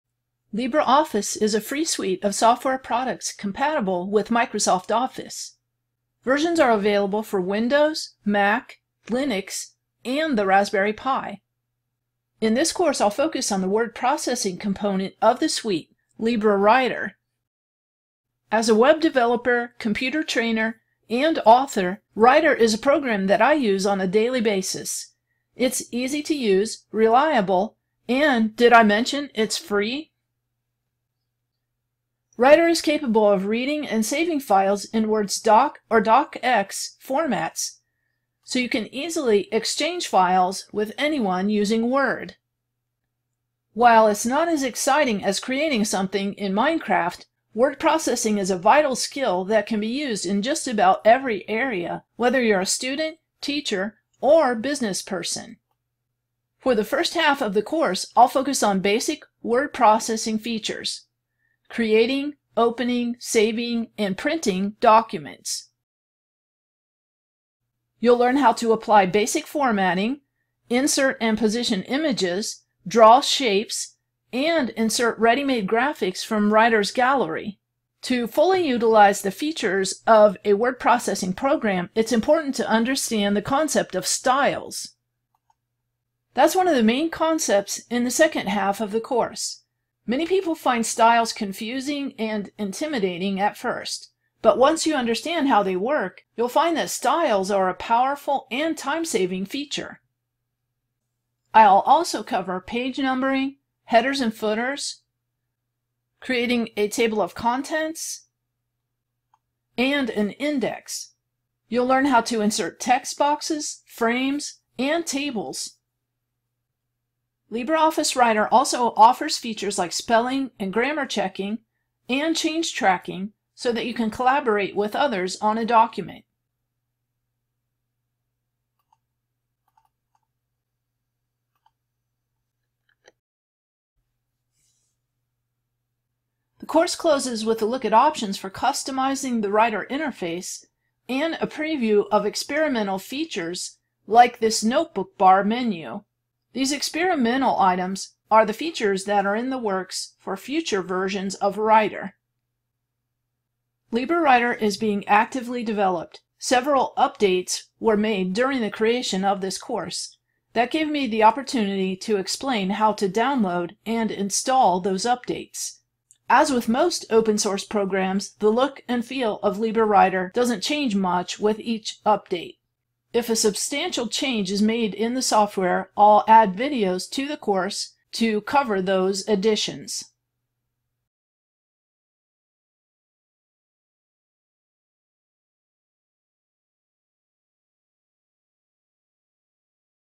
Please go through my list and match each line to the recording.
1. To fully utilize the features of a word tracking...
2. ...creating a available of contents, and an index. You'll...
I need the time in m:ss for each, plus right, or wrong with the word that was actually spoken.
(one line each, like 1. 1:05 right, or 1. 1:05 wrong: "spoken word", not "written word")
1. 1:18 wrong: "processing", not "tracking"
2. 1:46 wrong: "table", not "available".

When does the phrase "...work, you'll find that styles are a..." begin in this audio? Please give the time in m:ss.
1:35.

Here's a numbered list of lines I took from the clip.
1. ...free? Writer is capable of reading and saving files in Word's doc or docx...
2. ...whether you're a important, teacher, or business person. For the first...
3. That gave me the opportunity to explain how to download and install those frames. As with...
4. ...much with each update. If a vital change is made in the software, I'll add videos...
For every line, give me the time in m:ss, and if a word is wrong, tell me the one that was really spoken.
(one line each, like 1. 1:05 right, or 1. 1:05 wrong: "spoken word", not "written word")
1. 0:29 right
2. 0:52 wrong: "student", not "important"
3. 2:40 wrong: "updates", not "frames"
4. 2:50 wrong: "substantial", not "vital".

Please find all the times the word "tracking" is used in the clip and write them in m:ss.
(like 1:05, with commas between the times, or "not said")
2:02.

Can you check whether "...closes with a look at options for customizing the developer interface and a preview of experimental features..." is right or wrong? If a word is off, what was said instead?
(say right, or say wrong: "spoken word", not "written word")
wrong: "writer", not "developer".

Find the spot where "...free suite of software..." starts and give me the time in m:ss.
0:01.